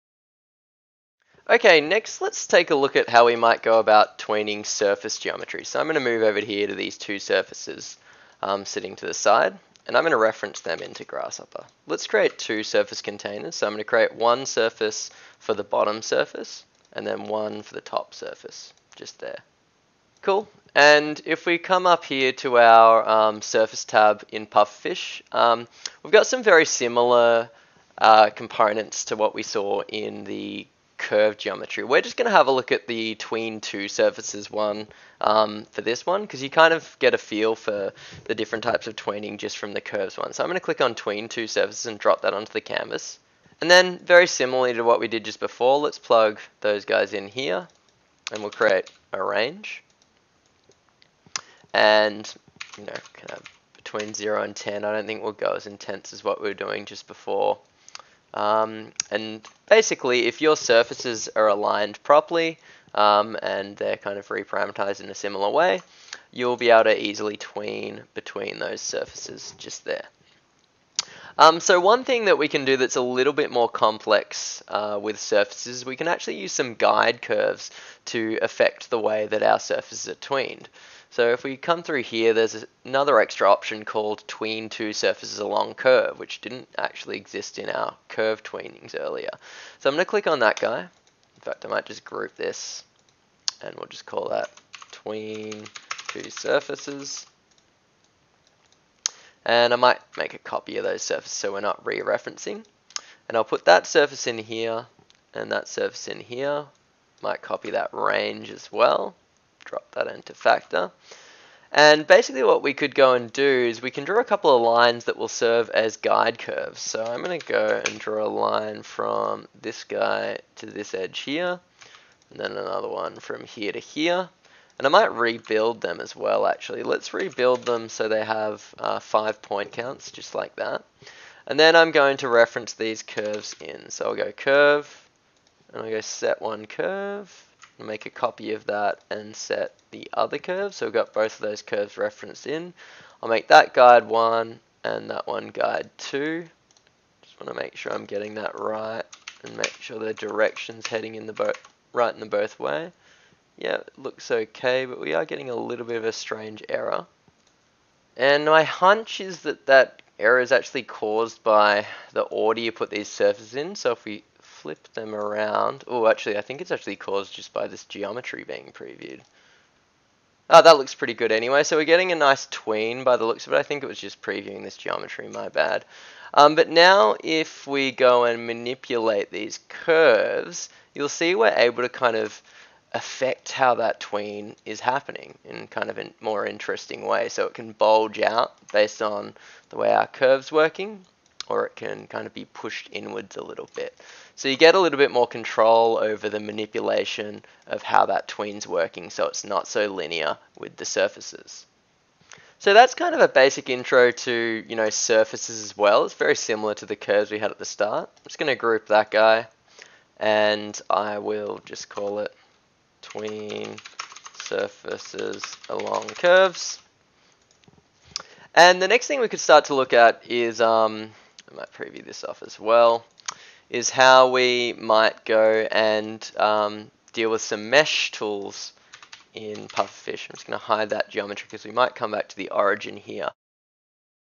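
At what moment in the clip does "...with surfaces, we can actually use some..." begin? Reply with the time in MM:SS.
01:15.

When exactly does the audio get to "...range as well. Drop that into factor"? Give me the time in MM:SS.
01:47.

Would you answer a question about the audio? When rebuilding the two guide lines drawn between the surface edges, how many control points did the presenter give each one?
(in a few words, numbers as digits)
5.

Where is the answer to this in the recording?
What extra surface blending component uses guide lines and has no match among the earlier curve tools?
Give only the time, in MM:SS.
01:24.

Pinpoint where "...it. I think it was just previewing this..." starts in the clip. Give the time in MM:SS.
02:53.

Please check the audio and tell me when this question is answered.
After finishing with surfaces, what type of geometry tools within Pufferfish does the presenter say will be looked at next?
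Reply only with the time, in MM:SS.
03:47.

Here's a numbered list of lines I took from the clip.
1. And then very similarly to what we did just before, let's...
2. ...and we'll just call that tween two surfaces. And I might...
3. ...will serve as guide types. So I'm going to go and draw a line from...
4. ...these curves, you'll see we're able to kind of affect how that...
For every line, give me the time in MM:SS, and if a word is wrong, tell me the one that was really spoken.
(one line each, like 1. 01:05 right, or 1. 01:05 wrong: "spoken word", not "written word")
1. 00:43 right
2. 01:33 right
3. 01:55 wrong: "curves", not "types"
4. 02:59 right.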